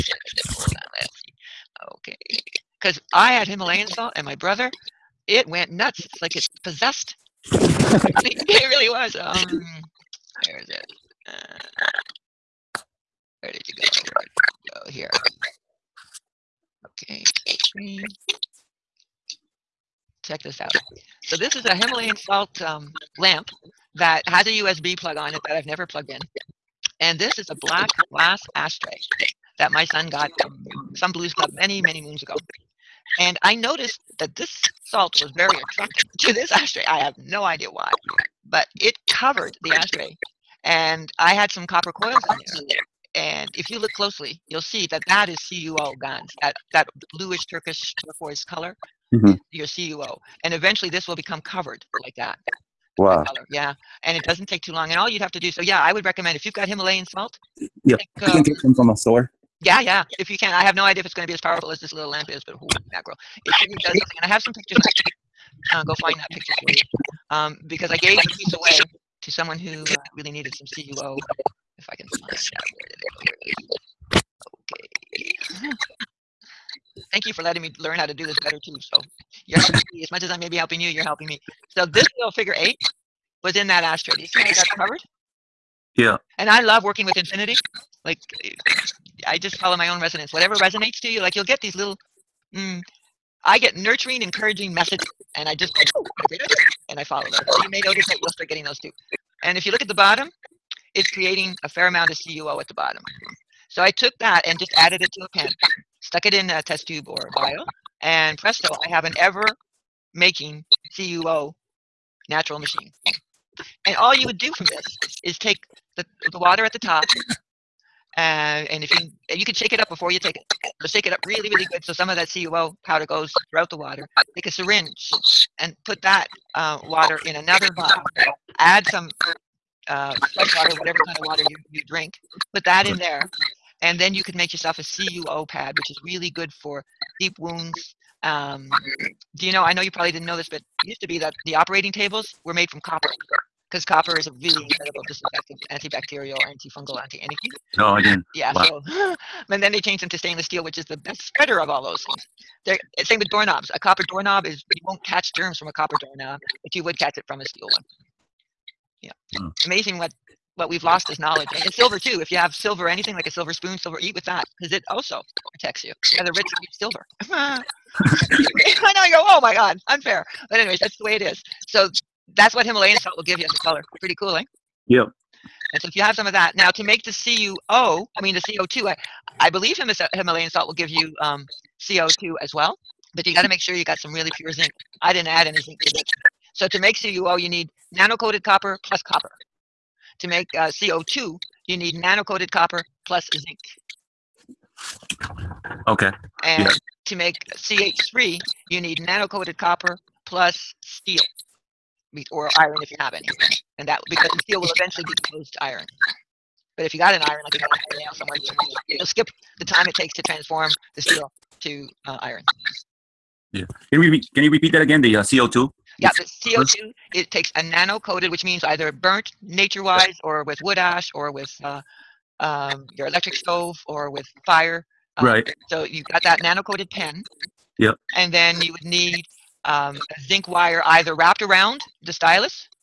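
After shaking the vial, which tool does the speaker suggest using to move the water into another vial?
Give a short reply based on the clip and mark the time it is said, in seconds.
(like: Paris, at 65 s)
Syringe, at 124 s.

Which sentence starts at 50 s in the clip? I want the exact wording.
And eventually this will become covered like that.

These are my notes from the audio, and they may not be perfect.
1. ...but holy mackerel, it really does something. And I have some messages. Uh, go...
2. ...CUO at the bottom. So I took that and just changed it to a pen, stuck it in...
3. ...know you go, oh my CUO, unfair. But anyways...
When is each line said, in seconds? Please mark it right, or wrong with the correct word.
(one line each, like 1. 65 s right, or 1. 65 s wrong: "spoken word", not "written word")
1. 62 s wrong: "pictures", not "messages"
2. 102 s wrong: "added", not "changed"
3. 168 s wrong: "God", not "CUO".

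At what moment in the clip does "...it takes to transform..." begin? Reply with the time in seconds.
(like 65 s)
209 s.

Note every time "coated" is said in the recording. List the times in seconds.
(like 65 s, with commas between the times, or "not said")
187 s, 191 s, 199 s, 217 s, 226 s.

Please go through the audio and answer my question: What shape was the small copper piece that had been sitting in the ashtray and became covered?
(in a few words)
Figure eight.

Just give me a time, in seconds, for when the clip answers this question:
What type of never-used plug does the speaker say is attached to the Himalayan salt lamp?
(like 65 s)
24 s.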